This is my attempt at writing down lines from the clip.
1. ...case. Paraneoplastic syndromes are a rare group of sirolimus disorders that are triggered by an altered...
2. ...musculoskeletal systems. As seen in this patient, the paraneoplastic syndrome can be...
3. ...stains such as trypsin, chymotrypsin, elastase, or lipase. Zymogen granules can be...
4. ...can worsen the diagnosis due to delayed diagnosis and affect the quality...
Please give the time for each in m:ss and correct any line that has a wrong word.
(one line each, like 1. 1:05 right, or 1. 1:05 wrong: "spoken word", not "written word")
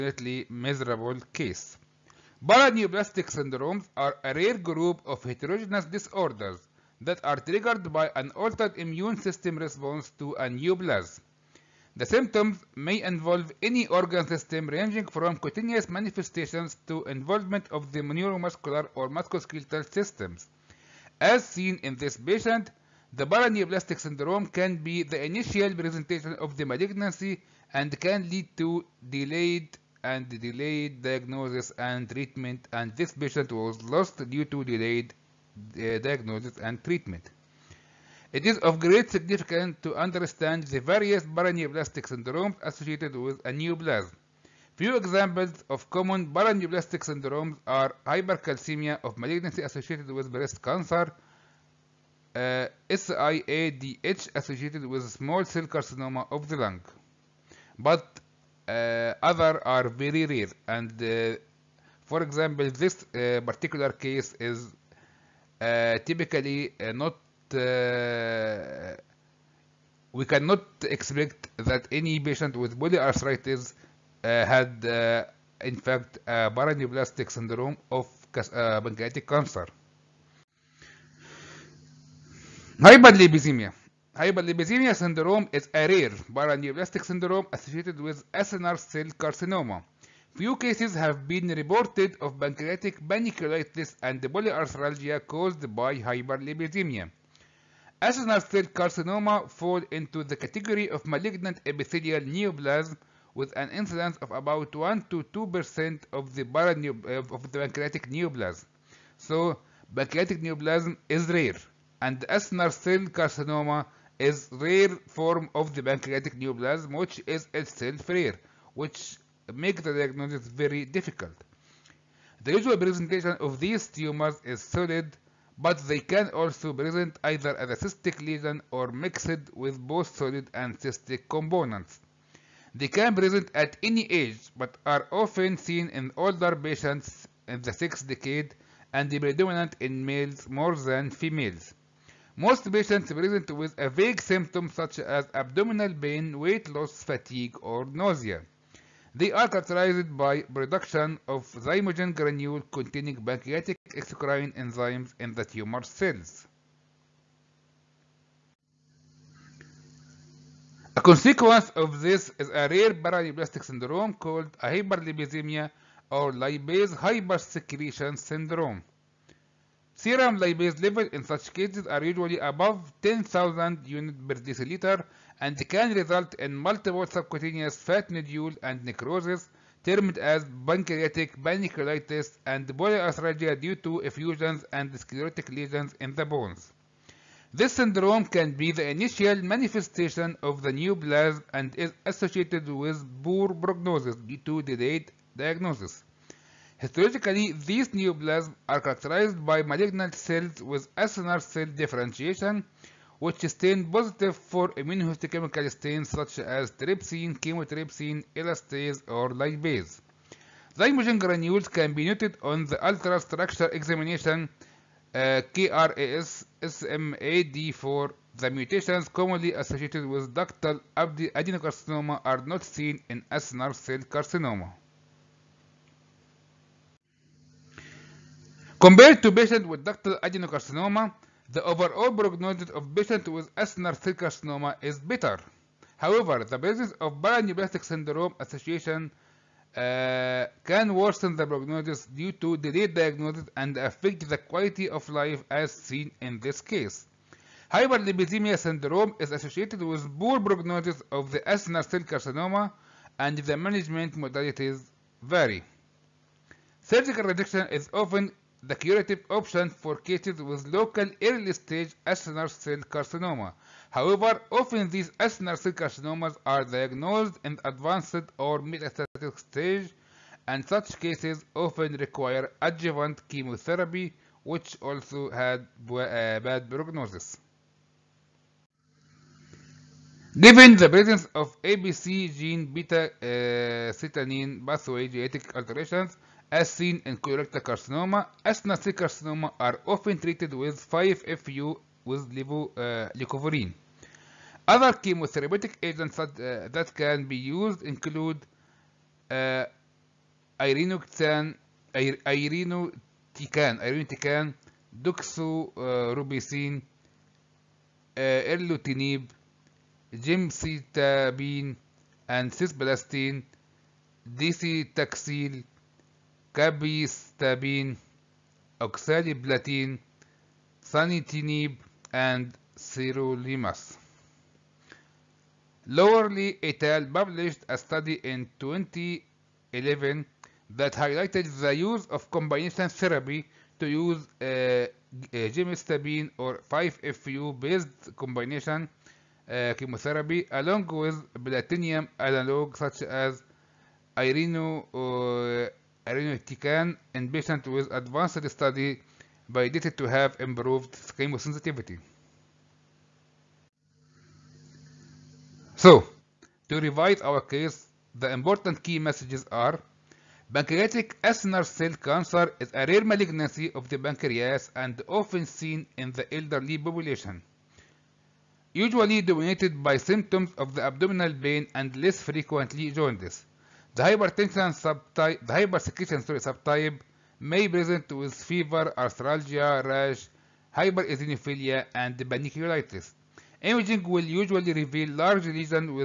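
1. 0:01 wrong: "heterogeneous", not "sirolimus"
2. 0:19 right
3. 3:25 right
4. 4:00 wrong: "prognosis", not "diagnosis".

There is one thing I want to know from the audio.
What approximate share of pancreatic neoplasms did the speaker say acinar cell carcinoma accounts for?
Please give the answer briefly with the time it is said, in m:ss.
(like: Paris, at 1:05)
1 to 2%, at 1:44.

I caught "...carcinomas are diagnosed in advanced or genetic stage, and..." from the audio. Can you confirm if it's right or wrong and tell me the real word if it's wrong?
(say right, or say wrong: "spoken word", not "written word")
wrong: "metastatic", not "genetic".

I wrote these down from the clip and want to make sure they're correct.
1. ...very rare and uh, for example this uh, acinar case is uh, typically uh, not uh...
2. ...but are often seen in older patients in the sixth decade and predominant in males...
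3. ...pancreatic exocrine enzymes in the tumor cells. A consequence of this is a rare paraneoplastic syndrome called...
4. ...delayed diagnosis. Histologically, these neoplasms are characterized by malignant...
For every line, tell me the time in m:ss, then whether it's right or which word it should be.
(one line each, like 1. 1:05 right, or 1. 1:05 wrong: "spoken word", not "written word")
1. 0:59 wrong: "particular", not "acinar"
2. 2:14 right
3. 2:33 right
4. 3:14 right.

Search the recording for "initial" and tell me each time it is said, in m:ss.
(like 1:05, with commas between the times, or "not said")
0:25, 3:08.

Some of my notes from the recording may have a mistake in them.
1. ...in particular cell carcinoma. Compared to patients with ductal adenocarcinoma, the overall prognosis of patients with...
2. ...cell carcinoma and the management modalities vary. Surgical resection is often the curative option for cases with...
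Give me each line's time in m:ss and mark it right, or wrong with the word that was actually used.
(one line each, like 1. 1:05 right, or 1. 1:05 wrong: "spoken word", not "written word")
1. 3:43 wrong: "acinar", not "particular"
2. 4:11 right.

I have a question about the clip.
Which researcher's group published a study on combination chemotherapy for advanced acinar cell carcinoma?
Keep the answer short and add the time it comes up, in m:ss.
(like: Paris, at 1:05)
Lowery et al., at 5:25.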